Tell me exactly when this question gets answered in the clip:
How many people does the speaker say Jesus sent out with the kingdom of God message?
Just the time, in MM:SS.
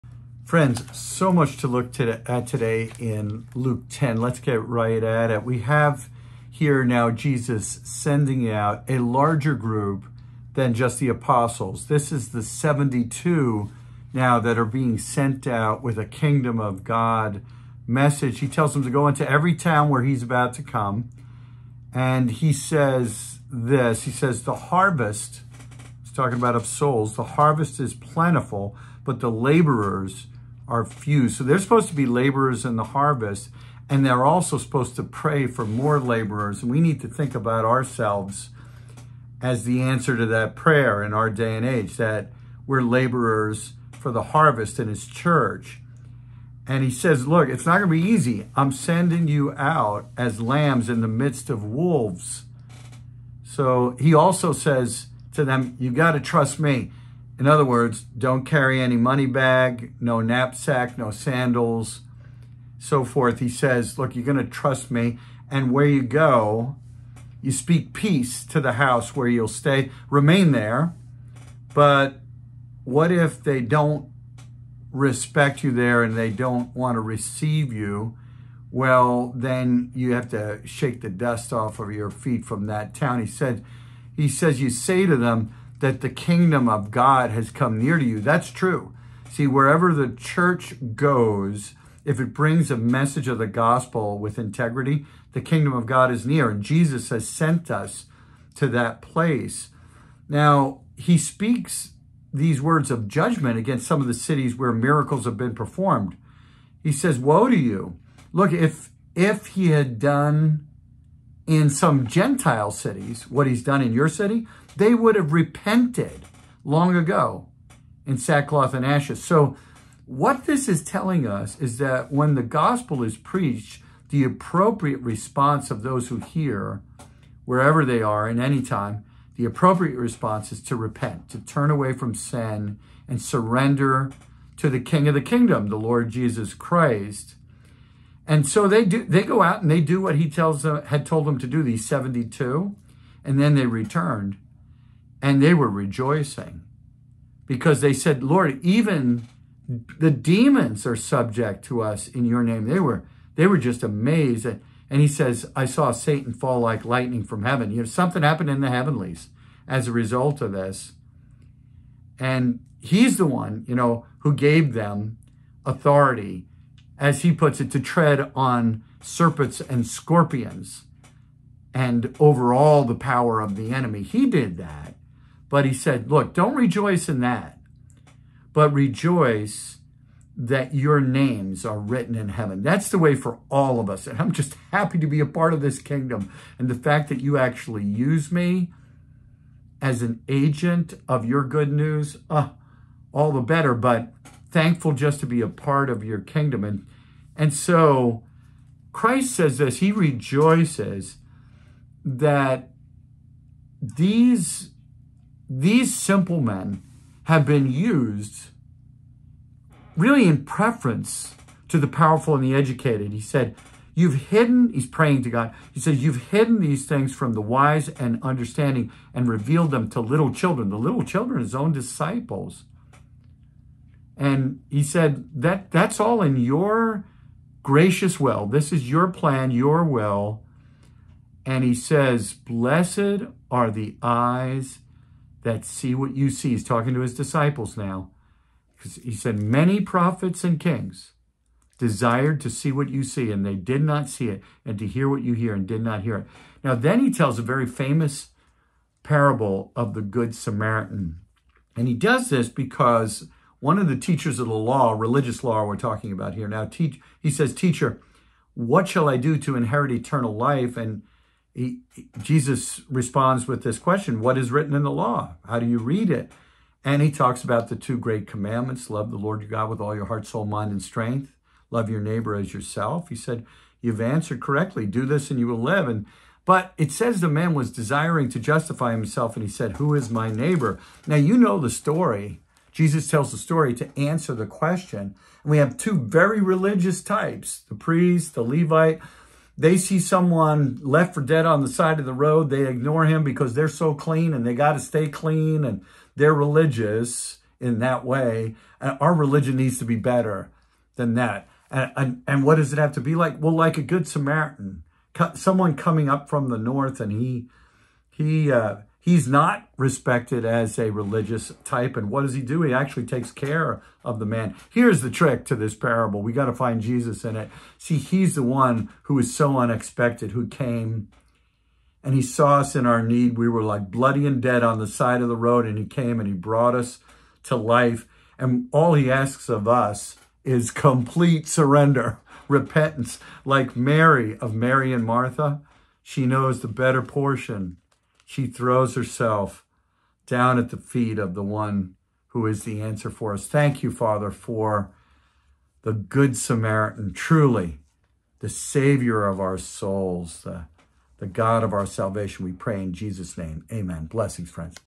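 00:12.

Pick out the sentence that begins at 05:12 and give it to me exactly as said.
He actually takes care of the man.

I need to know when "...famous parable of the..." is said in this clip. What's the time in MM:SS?
04:07.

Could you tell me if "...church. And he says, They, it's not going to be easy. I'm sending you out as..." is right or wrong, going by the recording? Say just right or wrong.
wrong.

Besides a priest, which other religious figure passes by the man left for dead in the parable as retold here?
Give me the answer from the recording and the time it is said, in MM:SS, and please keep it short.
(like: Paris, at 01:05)
the Levite, at 04:48.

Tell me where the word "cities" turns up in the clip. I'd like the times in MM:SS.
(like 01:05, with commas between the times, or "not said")
01:44, 01:52.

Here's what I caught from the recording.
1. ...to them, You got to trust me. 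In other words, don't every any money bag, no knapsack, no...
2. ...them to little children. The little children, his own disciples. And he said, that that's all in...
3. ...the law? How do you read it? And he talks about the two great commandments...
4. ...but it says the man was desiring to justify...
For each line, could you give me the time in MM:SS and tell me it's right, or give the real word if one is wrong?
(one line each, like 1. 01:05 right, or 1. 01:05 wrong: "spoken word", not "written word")
1. 00:55 wrong: "carry", not "every"
2. 03:39 right
3. 04:24 right
4. 04:36 right.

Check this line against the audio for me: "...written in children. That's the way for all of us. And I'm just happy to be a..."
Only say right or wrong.
wrong.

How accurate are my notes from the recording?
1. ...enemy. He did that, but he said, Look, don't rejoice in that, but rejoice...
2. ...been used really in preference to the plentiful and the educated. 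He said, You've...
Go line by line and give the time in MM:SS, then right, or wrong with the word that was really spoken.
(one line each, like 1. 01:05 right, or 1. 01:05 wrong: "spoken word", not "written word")
1. 02:53 right
2. 03:27 wrong: "powerful", not "plentiful".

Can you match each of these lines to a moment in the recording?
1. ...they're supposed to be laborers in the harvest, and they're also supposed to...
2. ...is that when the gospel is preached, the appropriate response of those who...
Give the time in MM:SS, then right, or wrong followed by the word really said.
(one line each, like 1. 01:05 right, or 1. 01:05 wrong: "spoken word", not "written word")
1. 00:31 right
2. 02:01 right.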